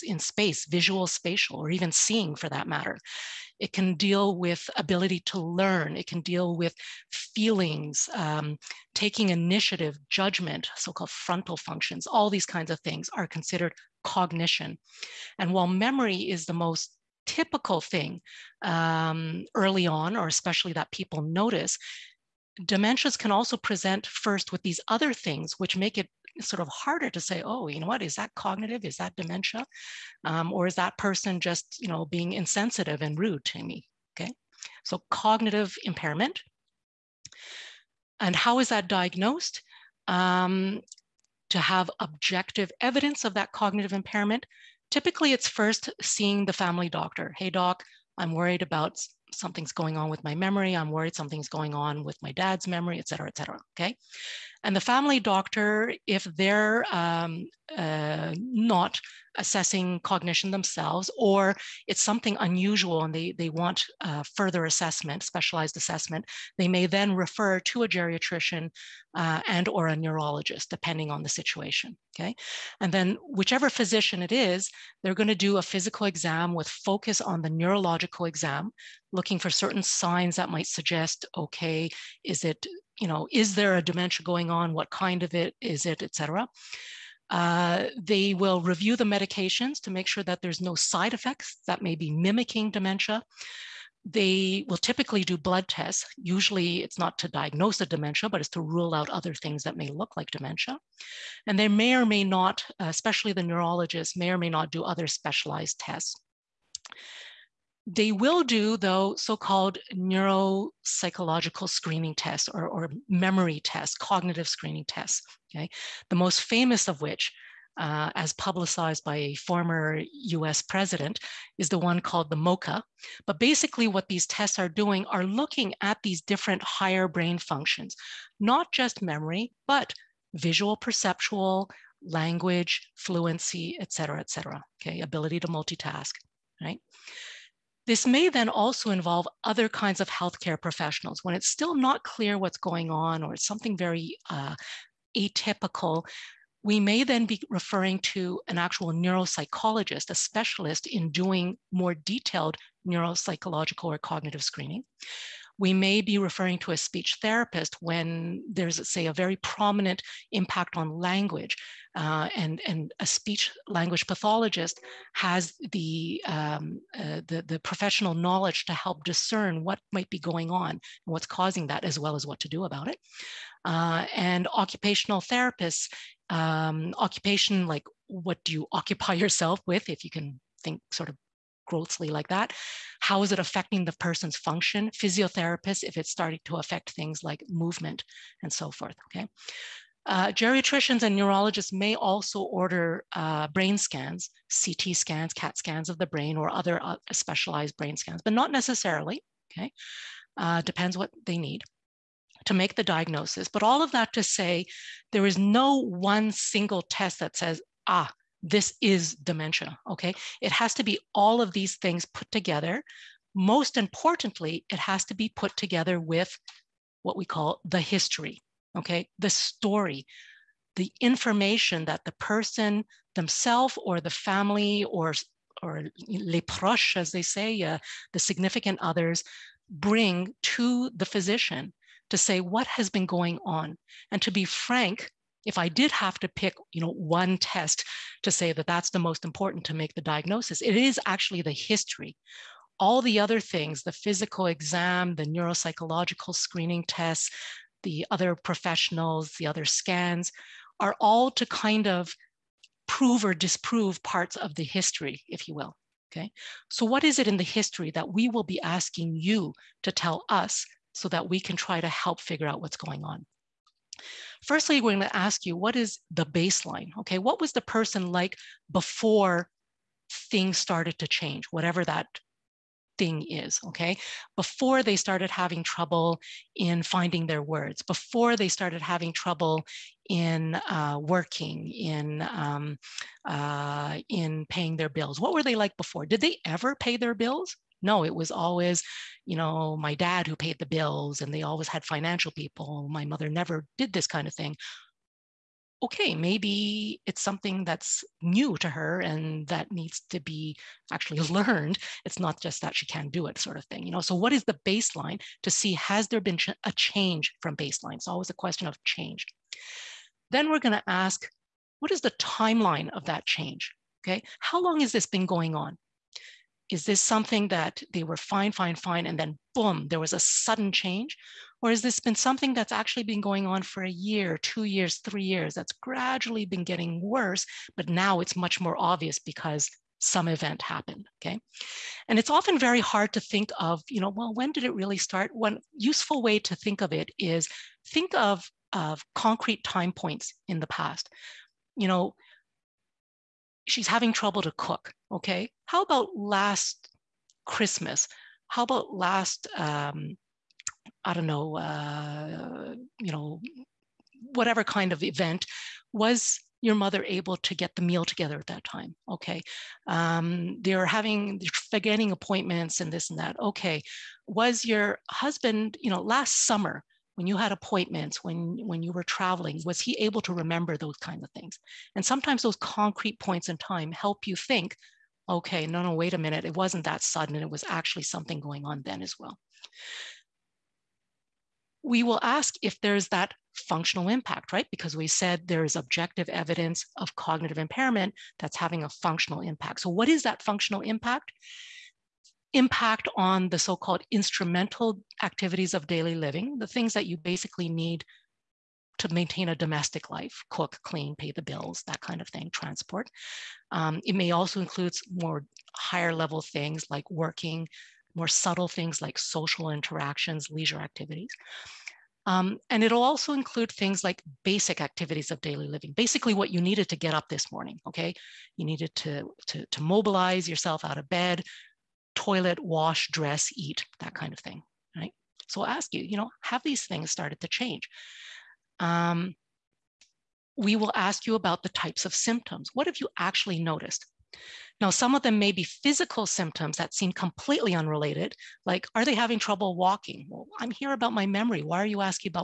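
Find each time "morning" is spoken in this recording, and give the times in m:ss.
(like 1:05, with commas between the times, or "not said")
6:57.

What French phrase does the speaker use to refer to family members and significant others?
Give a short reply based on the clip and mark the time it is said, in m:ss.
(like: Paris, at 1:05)
les proches, at 3:46.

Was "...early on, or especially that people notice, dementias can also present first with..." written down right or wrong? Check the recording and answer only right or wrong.
right.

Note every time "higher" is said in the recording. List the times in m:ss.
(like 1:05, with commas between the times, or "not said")
2:06, 6:45.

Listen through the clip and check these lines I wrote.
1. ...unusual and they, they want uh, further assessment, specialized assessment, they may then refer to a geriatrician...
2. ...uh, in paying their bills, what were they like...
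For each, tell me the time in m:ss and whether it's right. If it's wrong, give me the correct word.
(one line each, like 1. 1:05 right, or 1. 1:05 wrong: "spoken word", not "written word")
1. 1:02 right
2. 4:43 right.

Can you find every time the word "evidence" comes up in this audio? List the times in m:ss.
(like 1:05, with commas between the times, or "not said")
0:42, 6:26.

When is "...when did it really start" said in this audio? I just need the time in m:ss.
5:34.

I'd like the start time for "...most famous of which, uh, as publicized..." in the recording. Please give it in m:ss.
1:56.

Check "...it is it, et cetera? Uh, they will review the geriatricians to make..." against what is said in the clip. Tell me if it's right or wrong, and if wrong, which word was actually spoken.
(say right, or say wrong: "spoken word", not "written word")
wrong: "medications", not "geriatricians".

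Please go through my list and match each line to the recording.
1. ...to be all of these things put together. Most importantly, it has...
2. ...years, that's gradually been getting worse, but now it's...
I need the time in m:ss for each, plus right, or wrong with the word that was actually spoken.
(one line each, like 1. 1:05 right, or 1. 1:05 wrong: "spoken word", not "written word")
1. 3:30 right
2. 5:25 right.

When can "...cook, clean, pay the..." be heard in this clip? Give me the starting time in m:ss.
6:40.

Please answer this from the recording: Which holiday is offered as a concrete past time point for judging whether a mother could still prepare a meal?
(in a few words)
Christmas.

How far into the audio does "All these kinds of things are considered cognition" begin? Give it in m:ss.
0:12.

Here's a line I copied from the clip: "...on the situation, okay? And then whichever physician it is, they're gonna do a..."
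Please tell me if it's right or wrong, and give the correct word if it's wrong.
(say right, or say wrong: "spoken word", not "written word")
right.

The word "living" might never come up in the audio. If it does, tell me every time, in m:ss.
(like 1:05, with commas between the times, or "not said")
6:36, 6:55.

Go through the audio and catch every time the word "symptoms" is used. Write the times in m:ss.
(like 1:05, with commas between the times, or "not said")
7:12, 7:16.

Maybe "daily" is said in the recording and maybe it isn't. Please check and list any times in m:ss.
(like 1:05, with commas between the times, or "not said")
6:35, 6:55.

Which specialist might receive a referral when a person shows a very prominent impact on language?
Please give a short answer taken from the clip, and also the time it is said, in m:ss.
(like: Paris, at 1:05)
Speech therapist, at 2:36.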